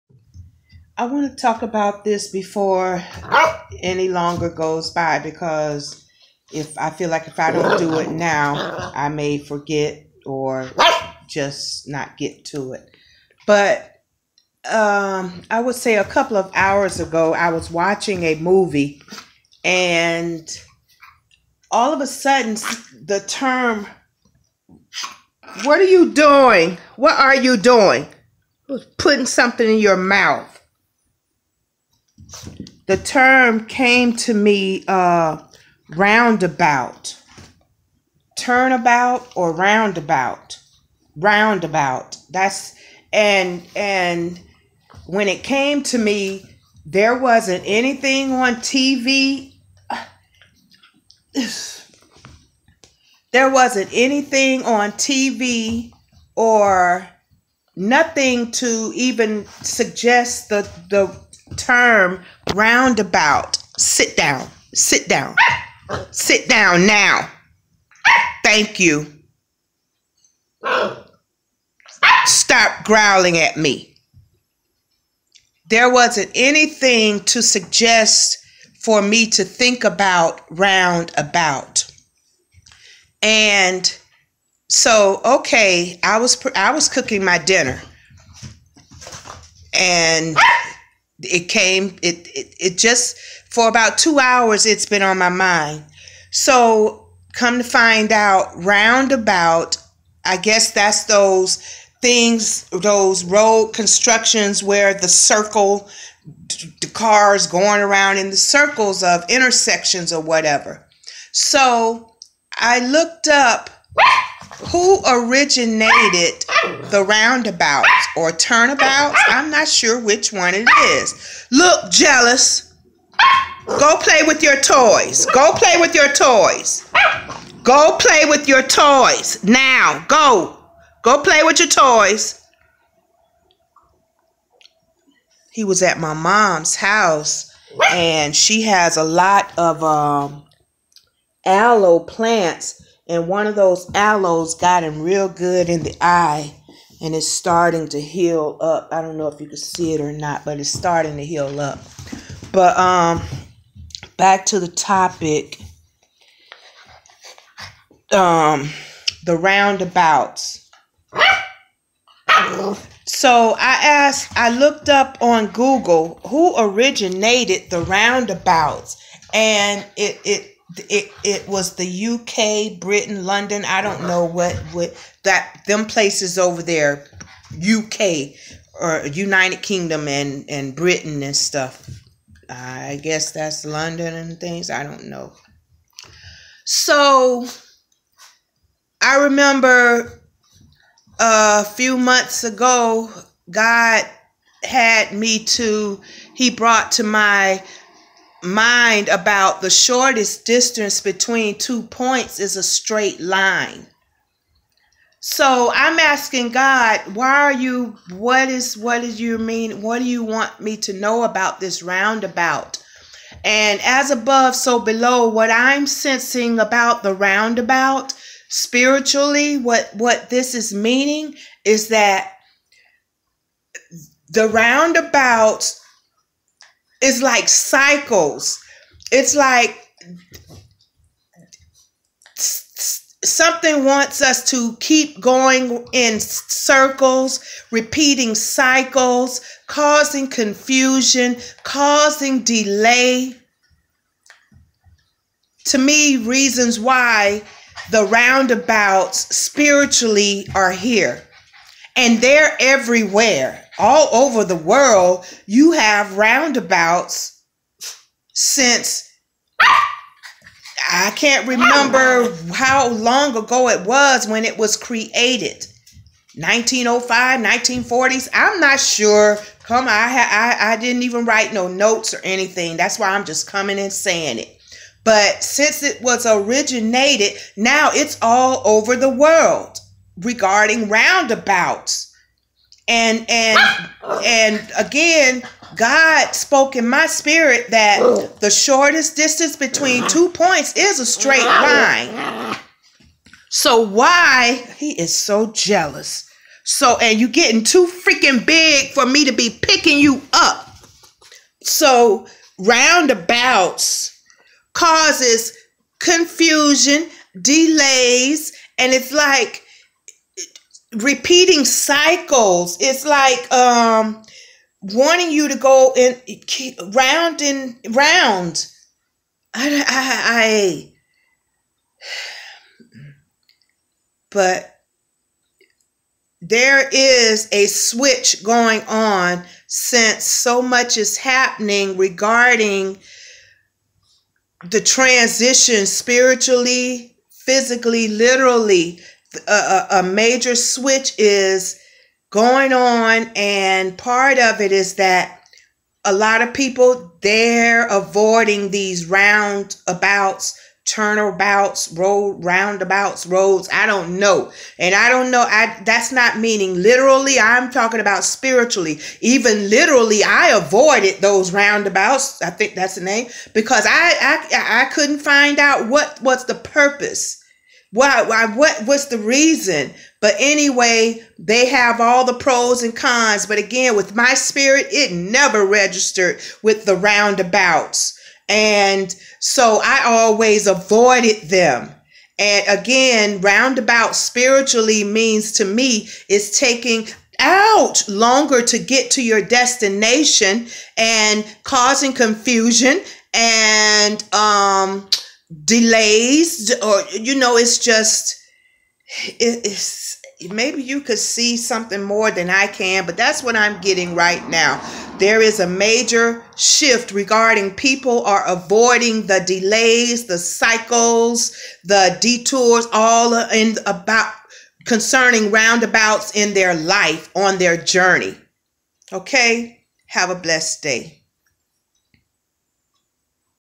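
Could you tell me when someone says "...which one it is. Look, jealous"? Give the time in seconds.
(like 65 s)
119 s.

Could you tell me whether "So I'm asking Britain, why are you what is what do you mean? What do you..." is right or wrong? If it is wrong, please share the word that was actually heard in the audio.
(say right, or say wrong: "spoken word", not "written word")
wrong: "God", not "Britain".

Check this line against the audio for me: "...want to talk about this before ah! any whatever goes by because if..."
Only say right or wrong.
wrong.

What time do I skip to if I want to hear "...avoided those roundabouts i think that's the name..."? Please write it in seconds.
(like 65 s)
360 s.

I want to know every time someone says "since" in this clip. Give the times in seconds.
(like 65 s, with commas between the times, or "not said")
258 s, 275 s, 329 s.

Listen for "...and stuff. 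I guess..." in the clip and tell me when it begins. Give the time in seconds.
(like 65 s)
181 s.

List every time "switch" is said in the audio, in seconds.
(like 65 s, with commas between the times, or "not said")
327 s, 340 s.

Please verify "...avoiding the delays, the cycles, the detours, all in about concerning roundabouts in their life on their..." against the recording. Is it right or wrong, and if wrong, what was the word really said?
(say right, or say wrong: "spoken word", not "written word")
right.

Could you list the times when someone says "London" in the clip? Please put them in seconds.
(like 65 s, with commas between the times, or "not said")
173 s, 183 s.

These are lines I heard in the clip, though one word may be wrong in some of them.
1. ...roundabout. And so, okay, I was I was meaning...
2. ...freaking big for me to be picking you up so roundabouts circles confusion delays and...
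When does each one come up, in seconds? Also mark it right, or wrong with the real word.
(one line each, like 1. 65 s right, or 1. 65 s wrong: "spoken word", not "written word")
1. 80 s wrong: "cooking", not "meaning"
2. 297 s wrong: "causes", not "circles".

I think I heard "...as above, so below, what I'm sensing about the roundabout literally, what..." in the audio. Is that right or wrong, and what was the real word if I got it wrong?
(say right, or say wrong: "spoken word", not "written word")
wrong: "spiritually", not "literally".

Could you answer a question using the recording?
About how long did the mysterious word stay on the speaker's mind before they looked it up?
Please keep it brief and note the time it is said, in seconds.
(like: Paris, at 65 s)
two hours, at 93 s.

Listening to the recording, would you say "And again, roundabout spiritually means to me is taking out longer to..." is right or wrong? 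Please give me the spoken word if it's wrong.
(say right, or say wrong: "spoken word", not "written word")
right.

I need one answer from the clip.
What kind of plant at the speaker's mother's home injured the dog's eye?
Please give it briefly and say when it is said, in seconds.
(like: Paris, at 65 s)
aloe, at 141 s.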